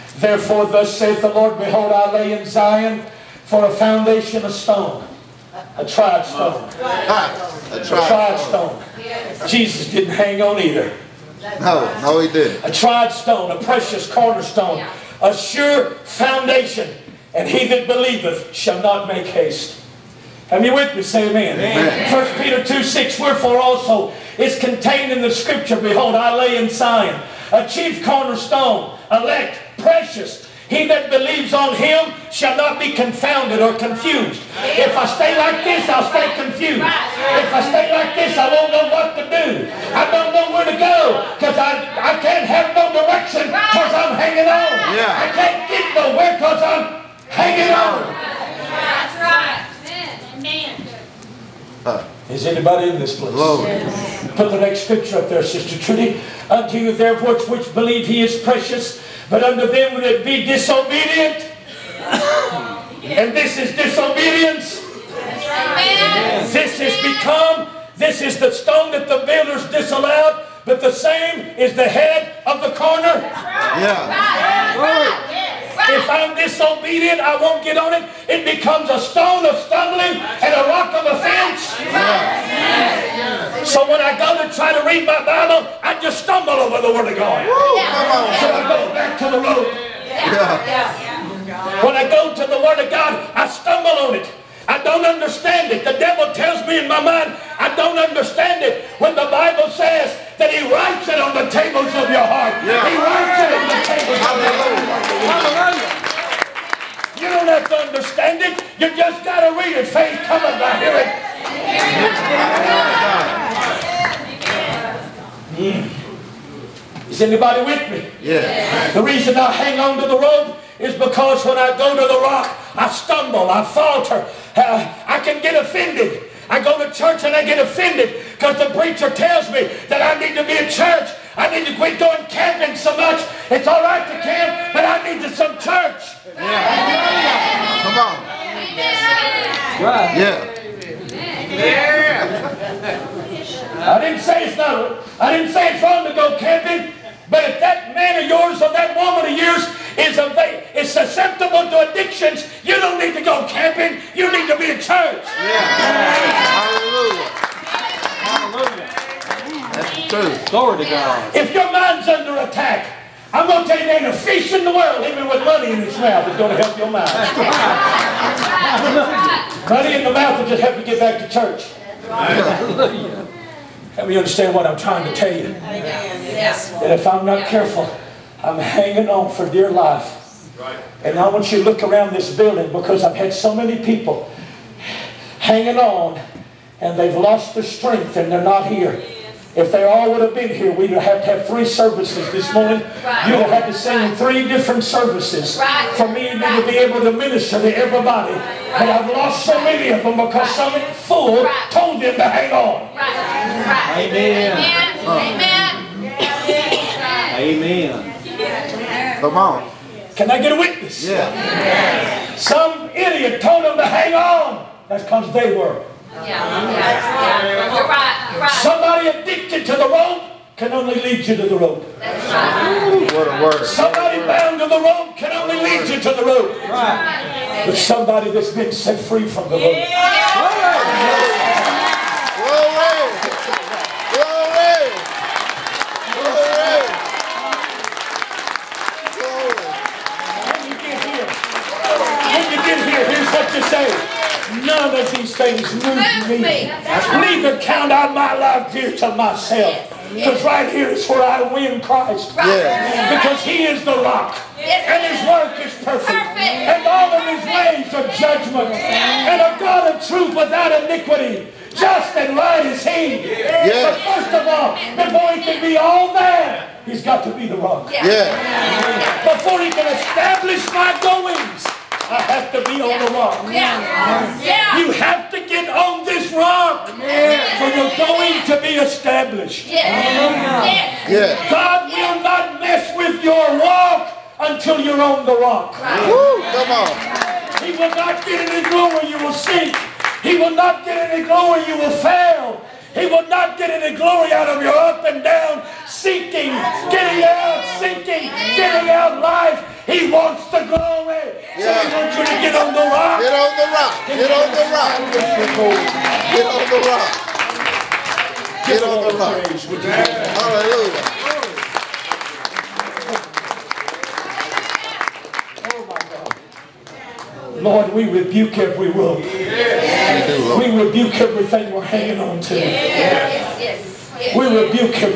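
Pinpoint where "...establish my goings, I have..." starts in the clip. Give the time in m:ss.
4:29.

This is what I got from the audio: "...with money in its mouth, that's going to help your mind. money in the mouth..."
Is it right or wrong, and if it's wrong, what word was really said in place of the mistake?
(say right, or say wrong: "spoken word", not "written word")
right.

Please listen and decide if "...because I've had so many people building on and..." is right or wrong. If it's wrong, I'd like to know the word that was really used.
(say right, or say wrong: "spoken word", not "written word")
wrong: "hanging", not "building".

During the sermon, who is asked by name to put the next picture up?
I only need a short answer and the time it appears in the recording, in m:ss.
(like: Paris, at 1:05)
Sister Trudy, at 0:55.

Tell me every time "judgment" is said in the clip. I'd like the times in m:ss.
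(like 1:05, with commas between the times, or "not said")
4:18.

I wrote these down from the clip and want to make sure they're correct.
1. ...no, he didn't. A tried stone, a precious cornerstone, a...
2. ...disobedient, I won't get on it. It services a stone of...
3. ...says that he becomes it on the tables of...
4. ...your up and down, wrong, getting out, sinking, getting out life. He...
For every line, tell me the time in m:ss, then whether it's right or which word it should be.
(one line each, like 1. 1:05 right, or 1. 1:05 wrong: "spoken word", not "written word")
1. 0:12 right
2. 1:16 wrong: "becomes", not "services"
3. 1:39 wrong: "writes", not "becomes"
4. 4:54 wrong: "sinking", not "wrong".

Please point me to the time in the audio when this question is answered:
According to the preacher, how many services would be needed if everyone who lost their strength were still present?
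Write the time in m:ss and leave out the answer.
3:11.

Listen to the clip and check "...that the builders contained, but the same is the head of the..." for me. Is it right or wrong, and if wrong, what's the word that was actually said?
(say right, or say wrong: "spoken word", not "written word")
wrong: "disallowed", not "contained".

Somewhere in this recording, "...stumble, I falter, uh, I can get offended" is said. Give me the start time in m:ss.
2:02.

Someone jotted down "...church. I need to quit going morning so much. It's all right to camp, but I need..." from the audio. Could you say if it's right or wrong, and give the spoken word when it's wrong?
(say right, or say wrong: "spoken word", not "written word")
wrong: "camping", not "morning".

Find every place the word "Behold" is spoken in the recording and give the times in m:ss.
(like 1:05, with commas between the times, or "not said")
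0:01, 0:25.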